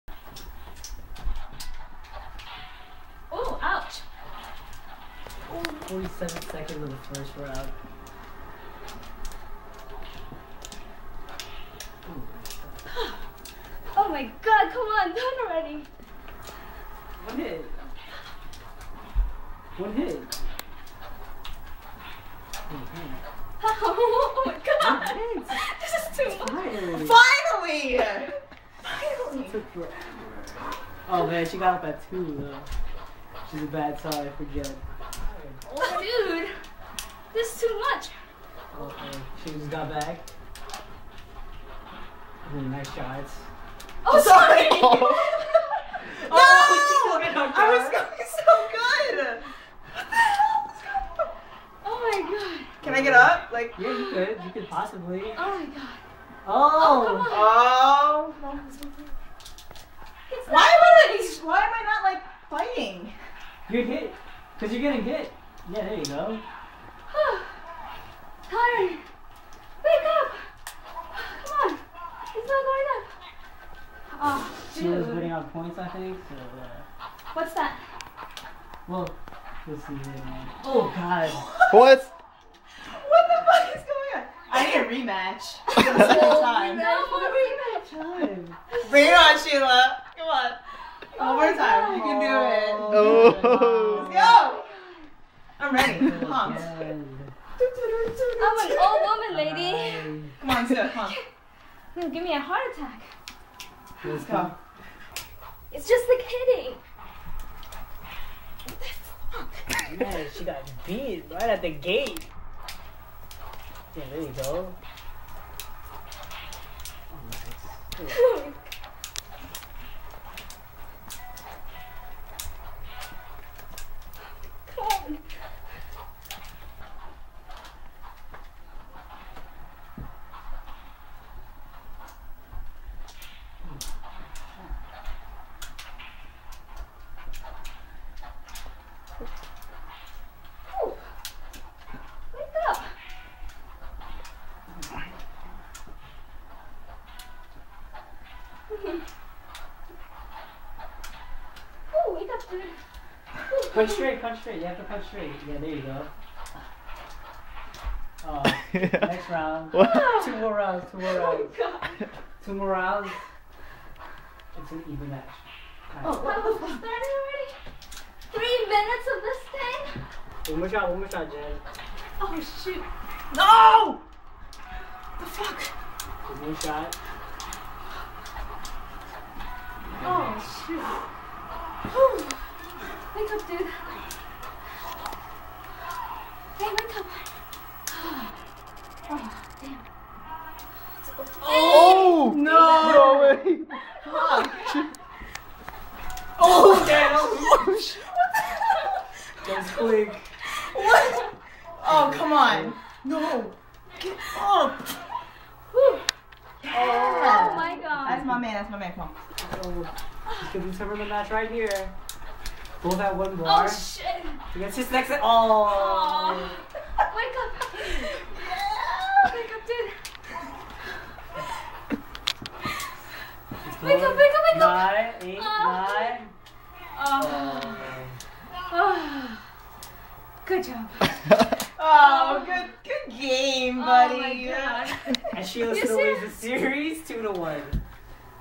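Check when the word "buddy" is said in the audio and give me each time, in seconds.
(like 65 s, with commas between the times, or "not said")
233 s.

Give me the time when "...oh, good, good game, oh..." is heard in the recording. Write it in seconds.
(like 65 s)
231 s.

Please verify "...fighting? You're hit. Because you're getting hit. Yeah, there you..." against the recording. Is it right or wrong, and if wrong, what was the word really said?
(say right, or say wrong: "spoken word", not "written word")
right.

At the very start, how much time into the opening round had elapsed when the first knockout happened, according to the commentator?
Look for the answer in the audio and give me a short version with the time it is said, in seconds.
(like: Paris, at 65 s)
47 seconds, at 5 s.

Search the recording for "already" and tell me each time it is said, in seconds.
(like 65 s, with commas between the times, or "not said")
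15 s, 166 s.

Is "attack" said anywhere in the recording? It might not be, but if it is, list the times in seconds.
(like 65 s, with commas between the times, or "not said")
102 s.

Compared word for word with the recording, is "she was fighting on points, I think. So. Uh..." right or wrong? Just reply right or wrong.
wrong.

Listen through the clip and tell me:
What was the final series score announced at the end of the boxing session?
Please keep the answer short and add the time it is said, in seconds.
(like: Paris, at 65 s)
2 to 1, at 237 s.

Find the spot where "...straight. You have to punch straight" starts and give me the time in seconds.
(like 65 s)
154 s.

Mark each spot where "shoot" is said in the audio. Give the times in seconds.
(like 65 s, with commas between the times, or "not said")
172 s, 180 s.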